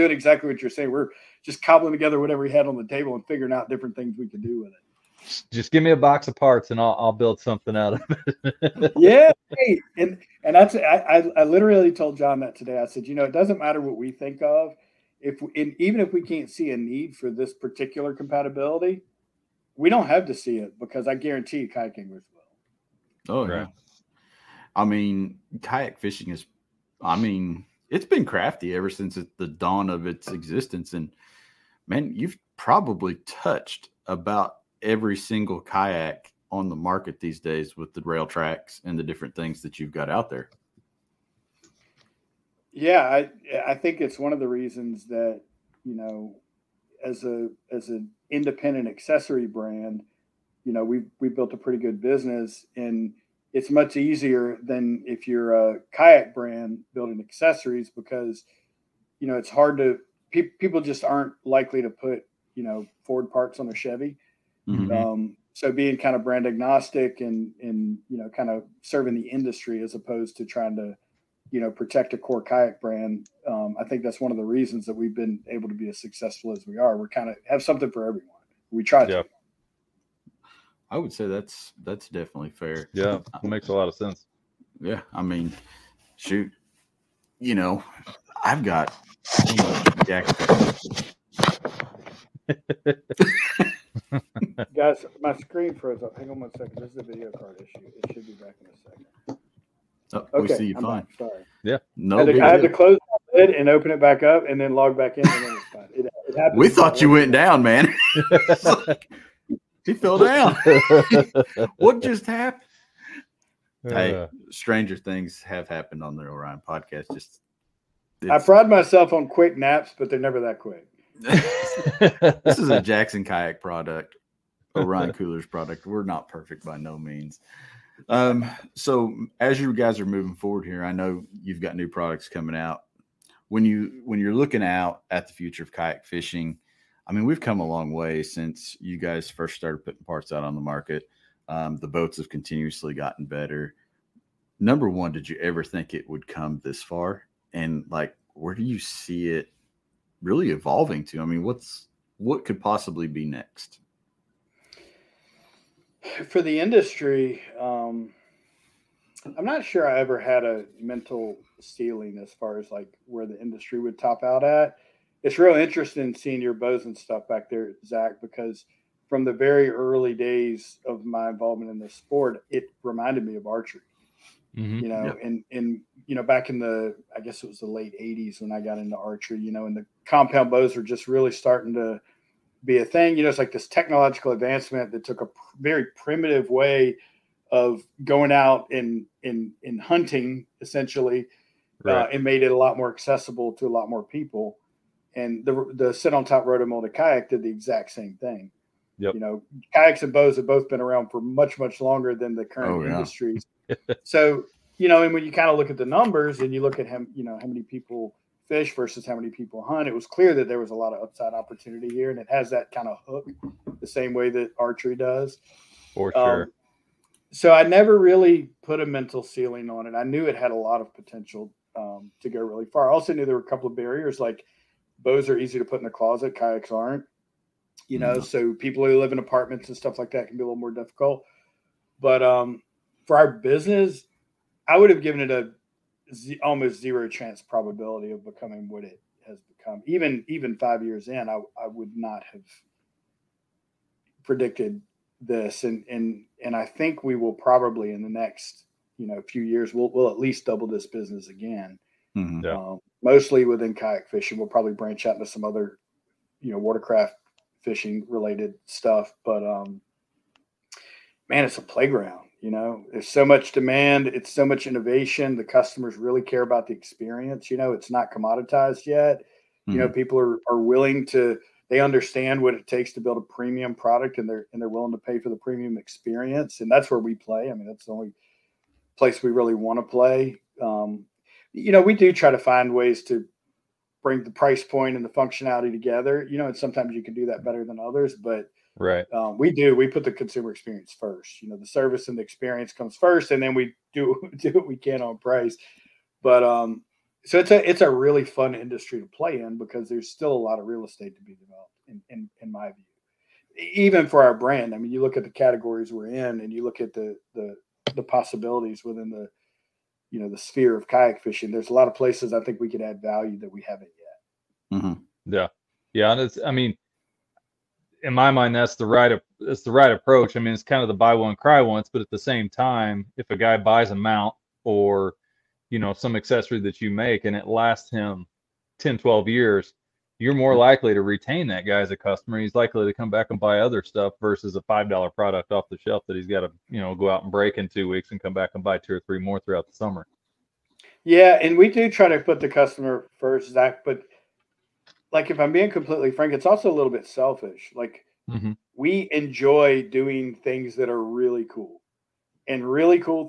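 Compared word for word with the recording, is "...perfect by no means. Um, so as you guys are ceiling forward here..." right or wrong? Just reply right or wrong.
wrong.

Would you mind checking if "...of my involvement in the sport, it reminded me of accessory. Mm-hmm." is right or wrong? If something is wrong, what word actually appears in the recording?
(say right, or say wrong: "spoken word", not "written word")
wrong: "archery", not "accessory".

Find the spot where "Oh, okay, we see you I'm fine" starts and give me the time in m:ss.
1:40.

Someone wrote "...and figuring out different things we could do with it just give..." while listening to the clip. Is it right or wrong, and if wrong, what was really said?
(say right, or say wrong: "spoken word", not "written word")
right.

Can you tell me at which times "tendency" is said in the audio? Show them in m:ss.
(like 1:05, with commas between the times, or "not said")
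not said.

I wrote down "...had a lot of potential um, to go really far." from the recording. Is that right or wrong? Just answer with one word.
right.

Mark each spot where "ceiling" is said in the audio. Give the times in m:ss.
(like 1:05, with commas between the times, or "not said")
2:41, 3:39.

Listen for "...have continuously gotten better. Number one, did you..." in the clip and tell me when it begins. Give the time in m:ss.
2:22.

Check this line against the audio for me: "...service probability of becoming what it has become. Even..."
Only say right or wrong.
wrong.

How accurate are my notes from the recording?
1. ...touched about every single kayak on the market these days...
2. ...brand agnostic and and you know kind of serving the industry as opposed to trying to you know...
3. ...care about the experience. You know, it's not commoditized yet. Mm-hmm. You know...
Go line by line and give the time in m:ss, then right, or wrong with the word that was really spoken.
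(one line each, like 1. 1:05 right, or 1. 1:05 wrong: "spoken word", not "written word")
1. 0:33 right
2. 1:06 right
3. 4:26 right.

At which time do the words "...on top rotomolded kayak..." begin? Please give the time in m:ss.
3:16.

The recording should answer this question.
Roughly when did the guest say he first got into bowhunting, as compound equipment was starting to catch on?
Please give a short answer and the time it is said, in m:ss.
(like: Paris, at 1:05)
late 80s, at 2:57.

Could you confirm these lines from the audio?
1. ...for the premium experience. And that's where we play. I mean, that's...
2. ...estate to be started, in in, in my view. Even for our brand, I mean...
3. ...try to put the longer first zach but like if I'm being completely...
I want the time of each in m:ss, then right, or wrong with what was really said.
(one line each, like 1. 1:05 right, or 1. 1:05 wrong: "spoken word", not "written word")
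1. 4:35 right
2. 5:00 wrong: "developed", not "started"
3. 5:41 wrong: "customer", not "longer".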